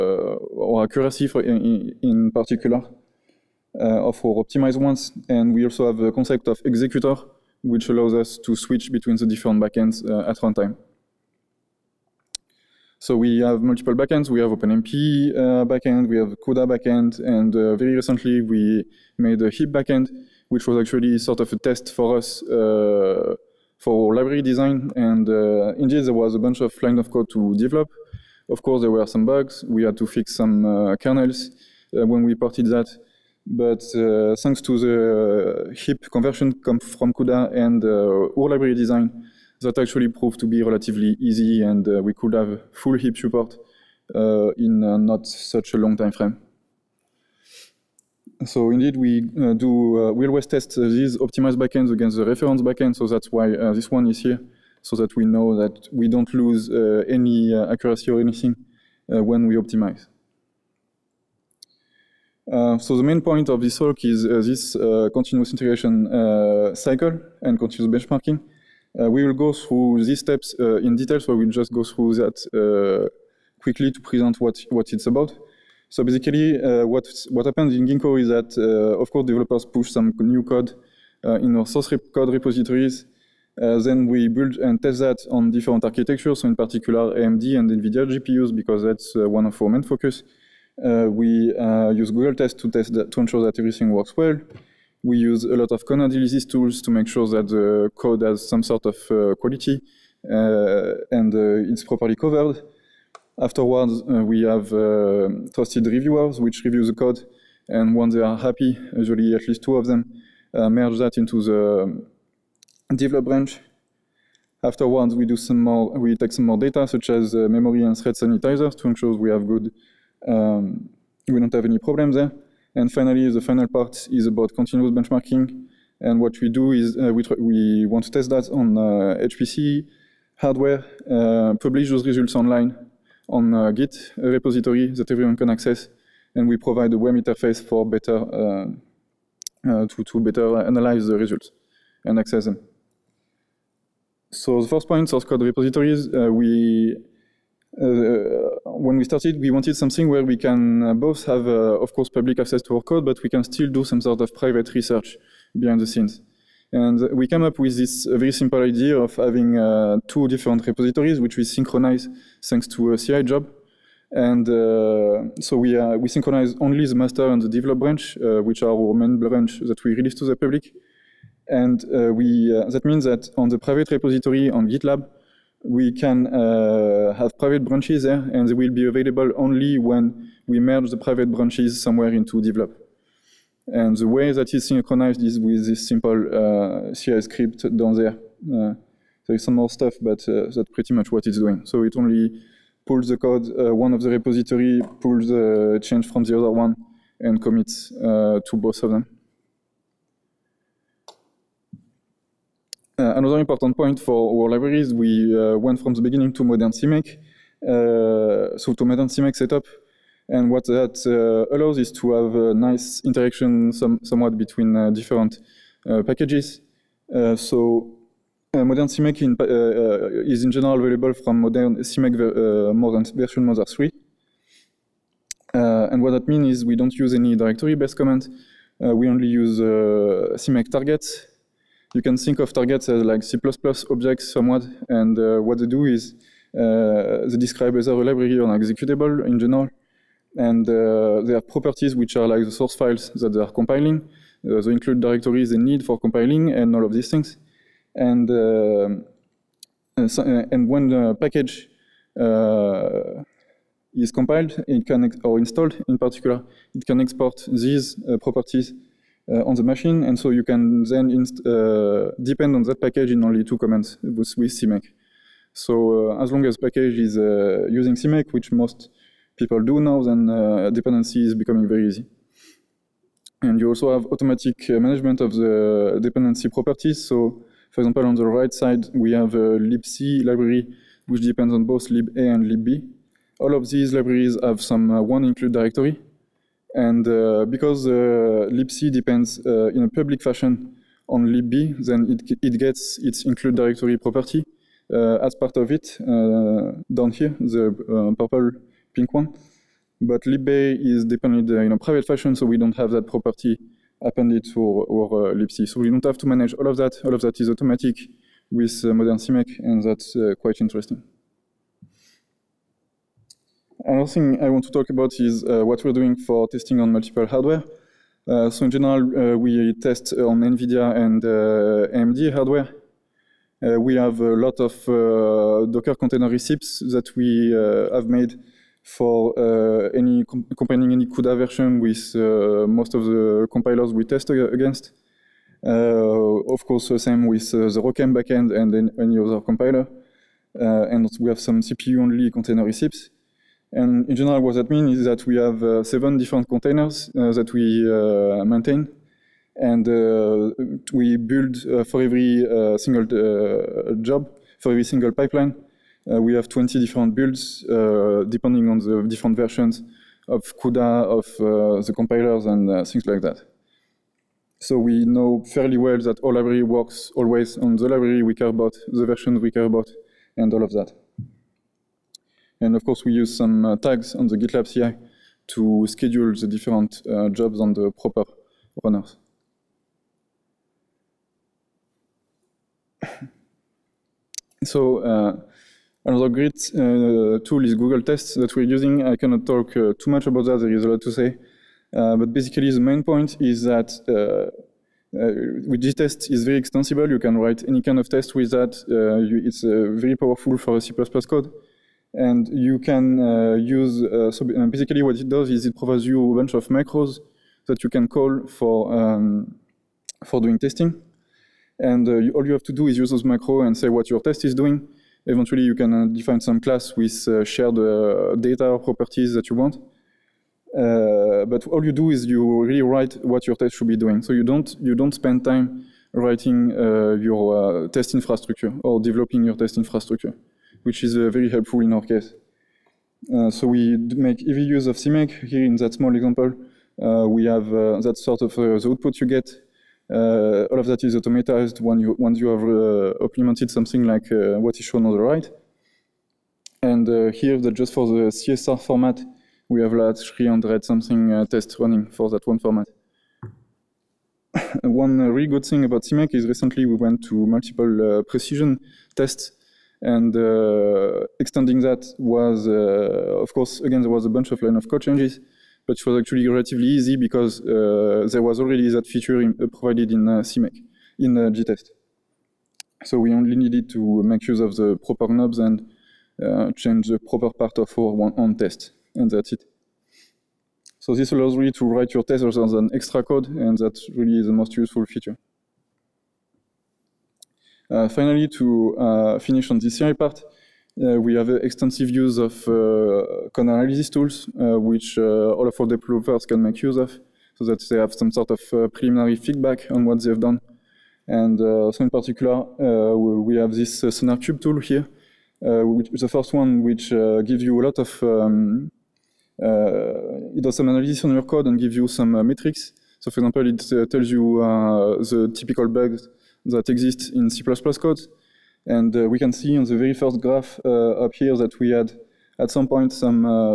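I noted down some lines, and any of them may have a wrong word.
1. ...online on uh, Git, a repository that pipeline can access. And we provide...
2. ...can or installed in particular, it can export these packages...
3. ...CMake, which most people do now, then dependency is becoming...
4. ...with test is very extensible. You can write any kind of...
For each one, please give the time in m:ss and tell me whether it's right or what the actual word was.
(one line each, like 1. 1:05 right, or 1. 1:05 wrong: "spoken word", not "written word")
1. 2:12 wrong: "everyone", not "pipeline"
2. 4:14 wrong: "properties", not "packages"
3. 4:27 right
4. 6:35 right.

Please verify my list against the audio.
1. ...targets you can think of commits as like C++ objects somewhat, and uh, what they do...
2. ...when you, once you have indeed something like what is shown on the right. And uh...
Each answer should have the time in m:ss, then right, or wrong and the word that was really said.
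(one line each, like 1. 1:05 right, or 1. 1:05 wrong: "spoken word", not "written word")
1. 3:50 wrong: "targets", not "commits"
2. 7:21 wrong: "implemented", not "indeed".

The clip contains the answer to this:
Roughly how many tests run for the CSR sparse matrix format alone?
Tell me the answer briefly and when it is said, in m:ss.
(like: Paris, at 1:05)
300, at 7:30.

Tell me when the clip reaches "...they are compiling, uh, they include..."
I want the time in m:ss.
4:03.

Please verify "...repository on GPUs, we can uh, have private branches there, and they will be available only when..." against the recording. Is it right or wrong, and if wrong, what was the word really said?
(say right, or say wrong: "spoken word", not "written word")
wrong: "GitLab", not "GPUs".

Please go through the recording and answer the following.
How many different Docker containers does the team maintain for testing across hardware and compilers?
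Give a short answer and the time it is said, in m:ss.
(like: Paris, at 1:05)
7, at 5:45.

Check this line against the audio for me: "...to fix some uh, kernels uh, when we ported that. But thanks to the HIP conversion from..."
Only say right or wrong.
right.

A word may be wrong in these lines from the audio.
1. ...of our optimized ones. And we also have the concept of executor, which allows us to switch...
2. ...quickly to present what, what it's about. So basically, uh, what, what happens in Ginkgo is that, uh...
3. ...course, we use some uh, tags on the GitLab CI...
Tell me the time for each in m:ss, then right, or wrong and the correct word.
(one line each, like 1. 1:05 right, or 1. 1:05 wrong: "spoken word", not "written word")
1. 0:03 right
2. 1:13 right
3. 6:12 right.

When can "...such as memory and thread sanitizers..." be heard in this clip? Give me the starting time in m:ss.
1:56.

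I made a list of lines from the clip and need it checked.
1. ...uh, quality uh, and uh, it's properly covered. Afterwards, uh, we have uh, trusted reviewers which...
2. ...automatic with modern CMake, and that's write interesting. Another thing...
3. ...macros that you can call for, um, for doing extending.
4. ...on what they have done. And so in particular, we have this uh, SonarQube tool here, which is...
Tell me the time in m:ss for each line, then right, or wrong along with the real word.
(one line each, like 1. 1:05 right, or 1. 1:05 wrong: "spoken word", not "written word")
1. 1:39 right
2. 5:07 wrong: "quite", not "write"
3. 6:46 wrong: "testing", not "extending"
4. 8:19 right.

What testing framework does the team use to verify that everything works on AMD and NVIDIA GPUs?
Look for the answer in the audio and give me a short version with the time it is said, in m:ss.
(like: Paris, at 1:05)
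Google Test, at 1:32.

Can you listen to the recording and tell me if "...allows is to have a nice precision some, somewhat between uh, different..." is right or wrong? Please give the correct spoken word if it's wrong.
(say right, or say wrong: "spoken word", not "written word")
wrong: "interaction", not "precision".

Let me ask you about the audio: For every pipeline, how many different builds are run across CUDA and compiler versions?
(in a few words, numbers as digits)
20.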